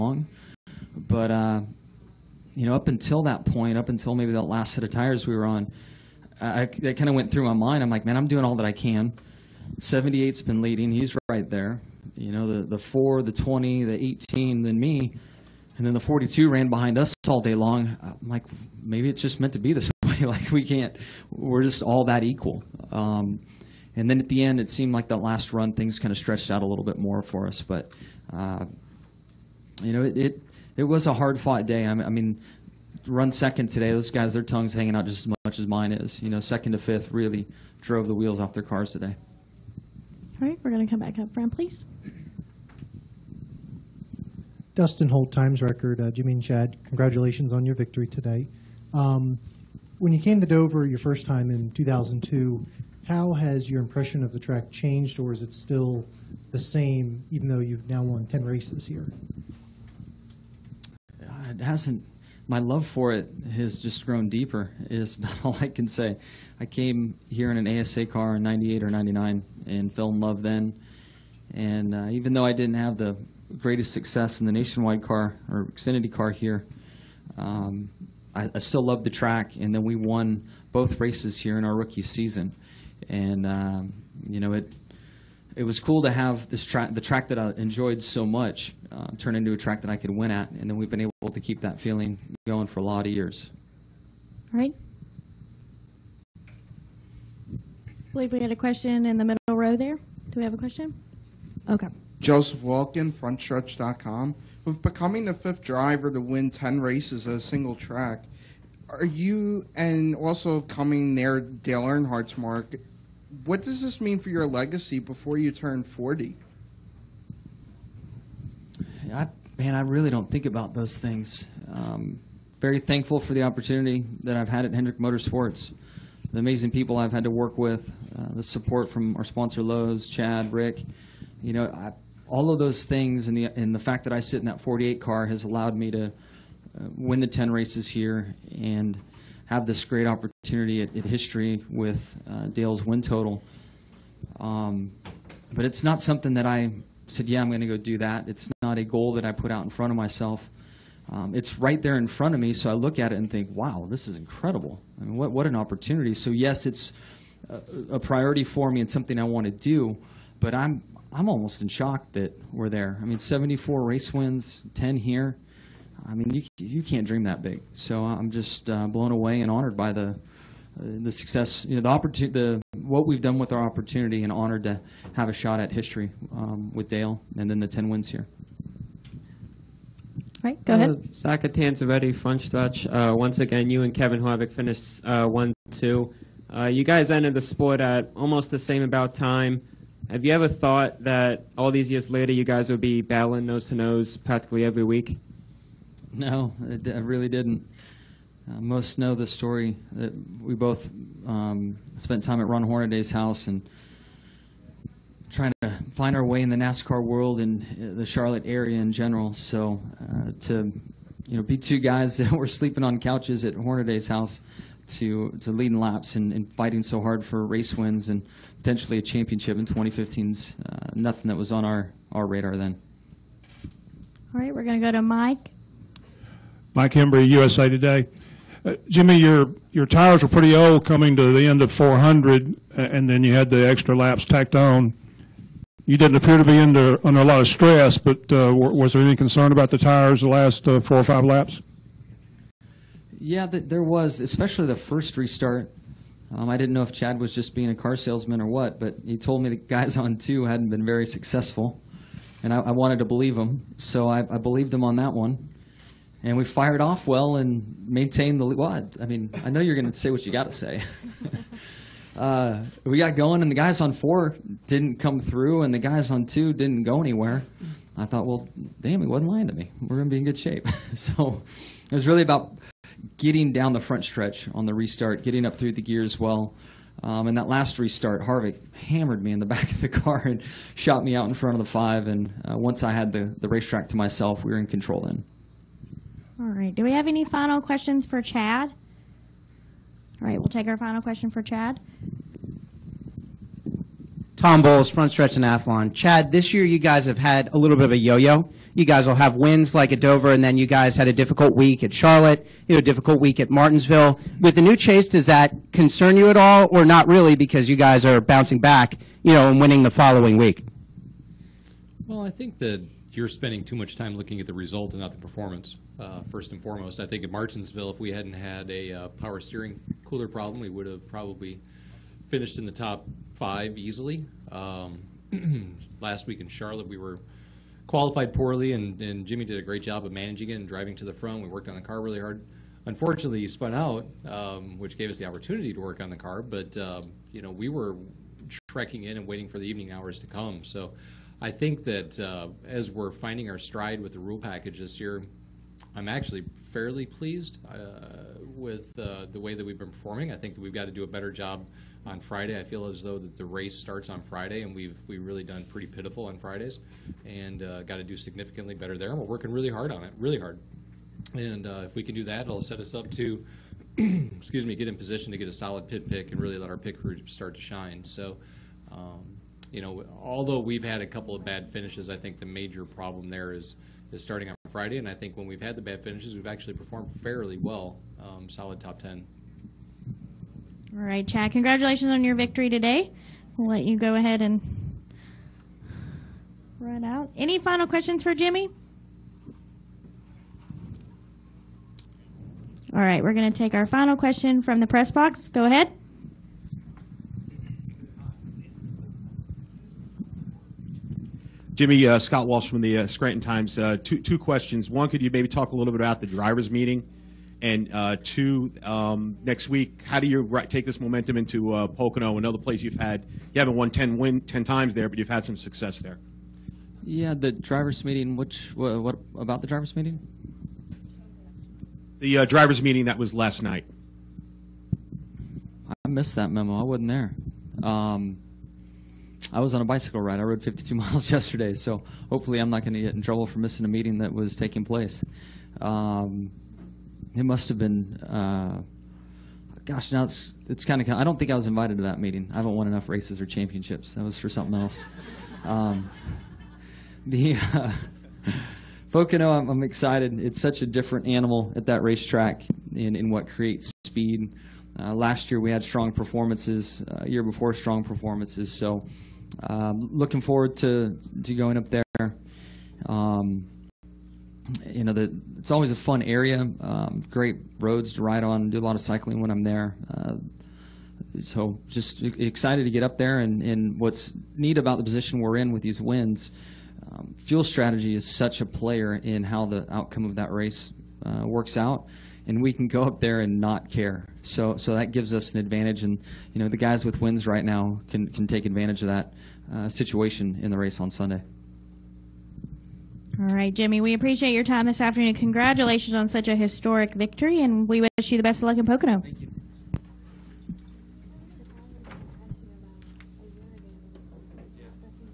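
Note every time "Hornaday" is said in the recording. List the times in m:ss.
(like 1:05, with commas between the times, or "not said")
3:22, 3:33.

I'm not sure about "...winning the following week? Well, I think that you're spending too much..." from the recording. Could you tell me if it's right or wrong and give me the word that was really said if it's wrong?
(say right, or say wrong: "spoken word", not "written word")
right.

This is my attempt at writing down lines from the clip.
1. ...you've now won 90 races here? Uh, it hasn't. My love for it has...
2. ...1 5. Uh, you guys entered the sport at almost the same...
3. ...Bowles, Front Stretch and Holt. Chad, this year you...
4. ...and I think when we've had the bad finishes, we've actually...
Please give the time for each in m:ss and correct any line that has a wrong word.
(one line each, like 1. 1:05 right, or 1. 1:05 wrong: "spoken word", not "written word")
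1. 0:57 wrong: "10", not "90"
2. 3:05 wrong: "2", not "5"
3. 4:54 wrong: "Athlon", not "Holt"
4. 6:14 right.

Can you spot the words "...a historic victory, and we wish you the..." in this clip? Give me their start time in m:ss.
8:16.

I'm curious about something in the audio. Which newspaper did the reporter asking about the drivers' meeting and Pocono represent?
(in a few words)
Scranton Times.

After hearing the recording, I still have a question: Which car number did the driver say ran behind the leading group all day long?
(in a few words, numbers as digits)
42.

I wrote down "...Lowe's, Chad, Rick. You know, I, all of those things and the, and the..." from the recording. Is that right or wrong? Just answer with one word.
right.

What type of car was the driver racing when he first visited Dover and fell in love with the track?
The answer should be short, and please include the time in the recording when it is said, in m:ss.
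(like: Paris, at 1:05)
ASA car, at 1:07.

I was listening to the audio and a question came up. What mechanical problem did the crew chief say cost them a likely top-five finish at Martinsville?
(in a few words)
Power steering cooler.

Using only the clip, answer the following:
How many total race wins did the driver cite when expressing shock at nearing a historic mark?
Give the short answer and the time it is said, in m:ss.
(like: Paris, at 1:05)
74, at 2:43.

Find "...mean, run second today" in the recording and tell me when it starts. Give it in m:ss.
0:32.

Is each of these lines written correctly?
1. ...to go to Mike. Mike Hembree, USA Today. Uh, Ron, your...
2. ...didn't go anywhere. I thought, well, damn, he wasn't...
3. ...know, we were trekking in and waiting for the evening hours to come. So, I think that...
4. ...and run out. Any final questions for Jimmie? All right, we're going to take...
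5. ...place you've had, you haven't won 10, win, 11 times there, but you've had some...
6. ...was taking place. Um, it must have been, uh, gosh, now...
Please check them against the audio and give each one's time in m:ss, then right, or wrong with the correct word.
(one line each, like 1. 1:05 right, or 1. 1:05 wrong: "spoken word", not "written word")
1. 3:44 wrong: "Jimmie", not "Ron"
2. 4:26 right
3. 5:37 right
4. 6:24 right
5. 6:52 wrong: "10", not "11"
6. 7:14 right.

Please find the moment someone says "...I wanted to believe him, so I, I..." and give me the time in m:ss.
4:12.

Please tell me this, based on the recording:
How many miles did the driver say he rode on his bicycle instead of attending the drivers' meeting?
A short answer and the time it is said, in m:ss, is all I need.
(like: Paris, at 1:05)
52, at 7:10.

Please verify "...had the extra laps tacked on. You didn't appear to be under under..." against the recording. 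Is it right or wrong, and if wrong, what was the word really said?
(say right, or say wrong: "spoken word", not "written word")
right.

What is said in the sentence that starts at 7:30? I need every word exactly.
It's such a different animal at that racetrack in in what creates speed.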